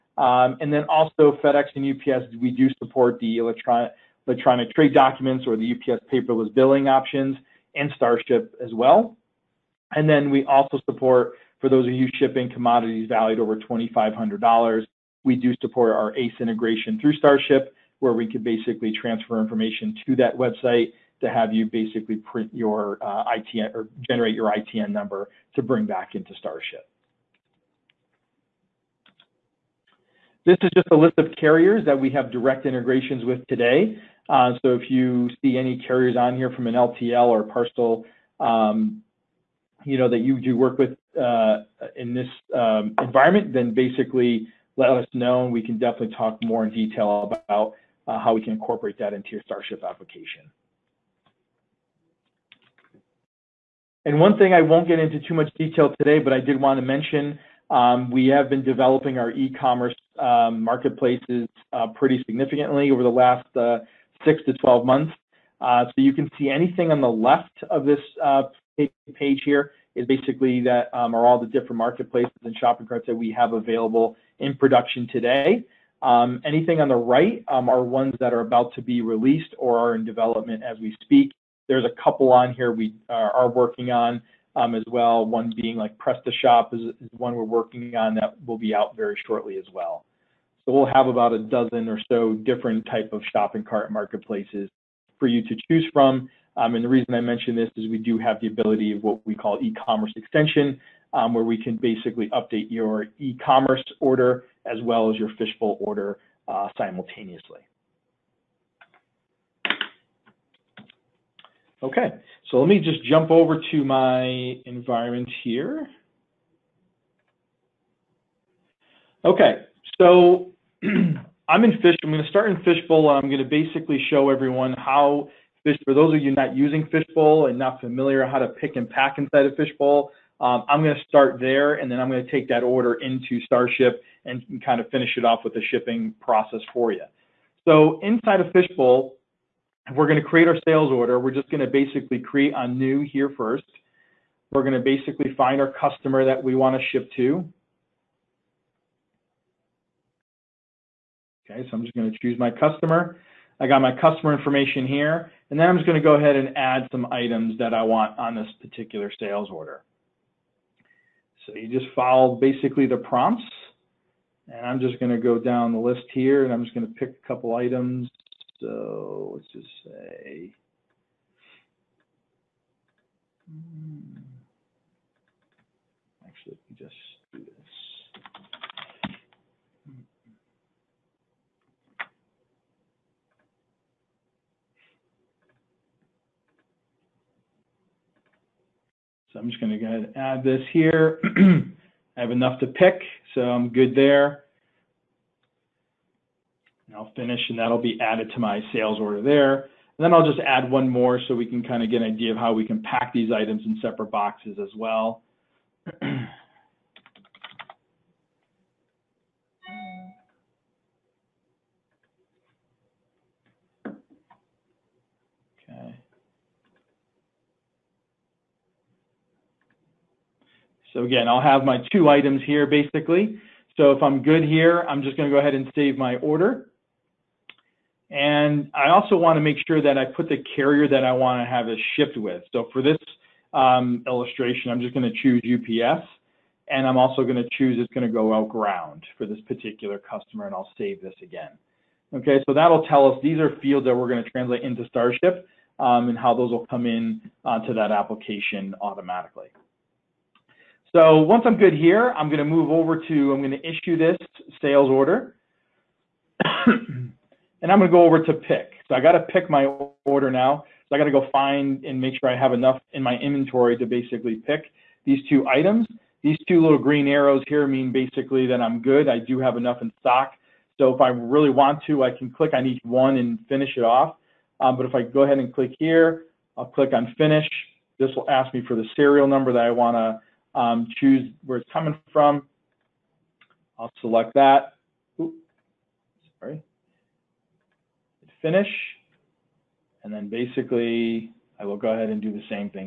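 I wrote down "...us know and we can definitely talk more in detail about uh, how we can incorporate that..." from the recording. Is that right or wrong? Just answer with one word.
right.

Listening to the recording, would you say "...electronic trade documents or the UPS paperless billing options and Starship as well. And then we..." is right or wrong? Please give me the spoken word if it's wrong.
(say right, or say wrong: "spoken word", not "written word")
right.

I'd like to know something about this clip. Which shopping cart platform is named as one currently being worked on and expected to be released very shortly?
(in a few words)
PrestaShop.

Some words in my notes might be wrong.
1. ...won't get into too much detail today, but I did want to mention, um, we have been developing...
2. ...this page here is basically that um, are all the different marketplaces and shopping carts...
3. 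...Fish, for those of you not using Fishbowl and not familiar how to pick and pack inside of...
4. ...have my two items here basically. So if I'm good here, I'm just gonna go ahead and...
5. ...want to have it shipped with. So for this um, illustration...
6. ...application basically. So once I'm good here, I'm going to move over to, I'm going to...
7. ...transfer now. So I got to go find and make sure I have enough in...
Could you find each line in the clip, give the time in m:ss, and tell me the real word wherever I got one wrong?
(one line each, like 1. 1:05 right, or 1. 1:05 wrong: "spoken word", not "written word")
1. 0:54 right
2. 1:07 right
3. 2:05 right
4. 3:41 right
5. 3:51 right
6. 4:07 wrong: "automatically", not "basically"
7. 4:20 wrong: "order", not "transfer".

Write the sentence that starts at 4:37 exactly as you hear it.
This will ask me for the serial number that I want to um, choose where it's coming from.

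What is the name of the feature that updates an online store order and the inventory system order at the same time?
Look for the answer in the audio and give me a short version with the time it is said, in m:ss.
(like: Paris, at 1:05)
e-commerce extension, at 1:39.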